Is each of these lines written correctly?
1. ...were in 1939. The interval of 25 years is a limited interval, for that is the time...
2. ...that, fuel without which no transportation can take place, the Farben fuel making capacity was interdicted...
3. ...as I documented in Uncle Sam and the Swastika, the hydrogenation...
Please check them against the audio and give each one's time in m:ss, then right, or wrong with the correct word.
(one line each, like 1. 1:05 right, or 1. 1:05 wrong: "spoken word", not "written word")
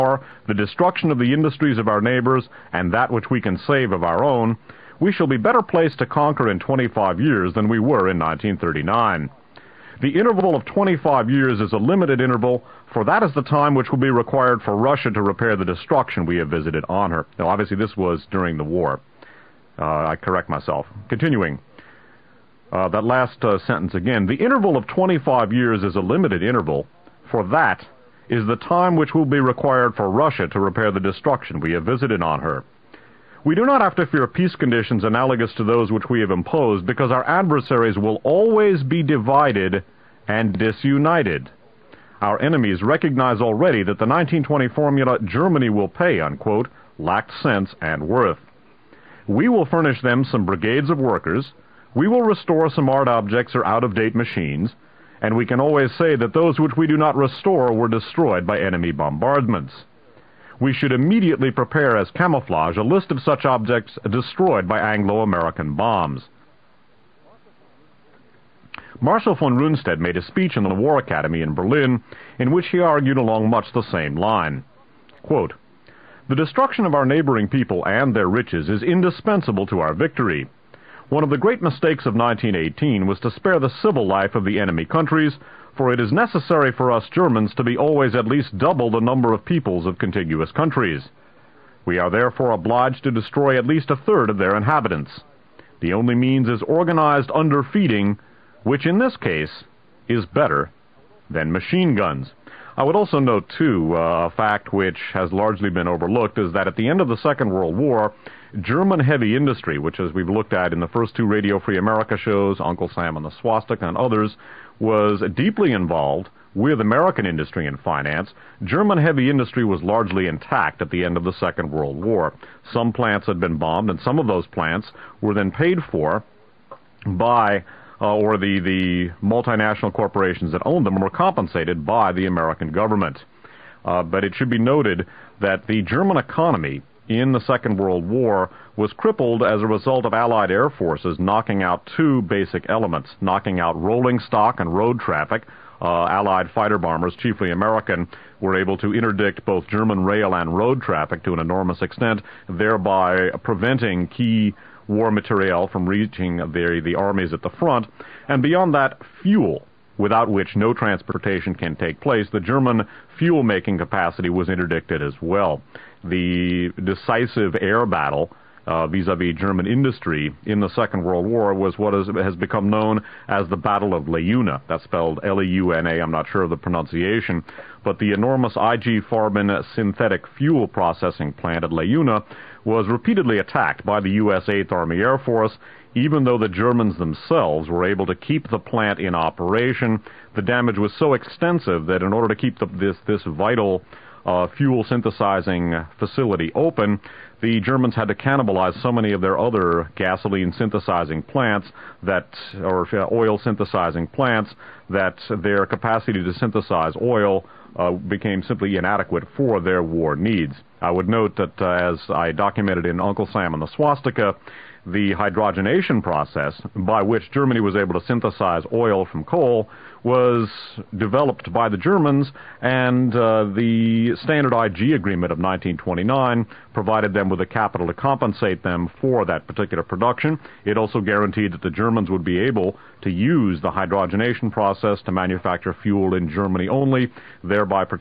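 1. 0:07 right
2. 2:38 wrong: "German", not "Farben"
3. 3:31 right.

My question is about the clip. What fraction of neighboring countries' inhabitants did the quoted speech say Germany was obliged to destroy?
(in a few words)
a third.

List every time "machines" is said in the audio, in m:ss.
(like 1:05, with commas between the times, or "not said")
0:54, 1:41.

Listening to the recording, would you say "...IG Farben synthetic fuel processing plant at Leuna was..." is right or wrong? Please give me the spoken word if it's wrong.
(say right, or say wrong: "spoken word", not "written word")
right.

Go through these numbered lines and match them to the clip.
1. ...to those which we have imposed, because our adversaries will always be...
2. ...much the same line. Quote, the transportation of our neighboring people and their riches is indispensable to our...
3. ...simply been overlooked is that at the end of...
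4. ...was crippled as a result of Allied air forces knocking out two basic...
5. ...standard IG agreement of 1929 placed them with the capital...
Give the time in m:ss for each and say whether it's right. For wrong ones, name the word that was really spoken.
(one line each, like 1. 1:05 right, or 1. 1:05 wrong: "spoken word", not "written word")
1. 0:35 right
2. 1:13 wrong: "destruction", not "transportation"
3. 1:45 wrong: "largely", not "simply"
4. 2:18 right
5. 3:44 wrong: "provided", not "placed".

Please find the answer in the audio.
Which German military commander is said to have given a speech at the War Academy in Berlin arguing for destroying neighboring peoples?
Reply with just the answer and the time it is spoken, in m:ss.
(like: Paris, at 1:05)
Marshal von Rundstedt, at 1:08.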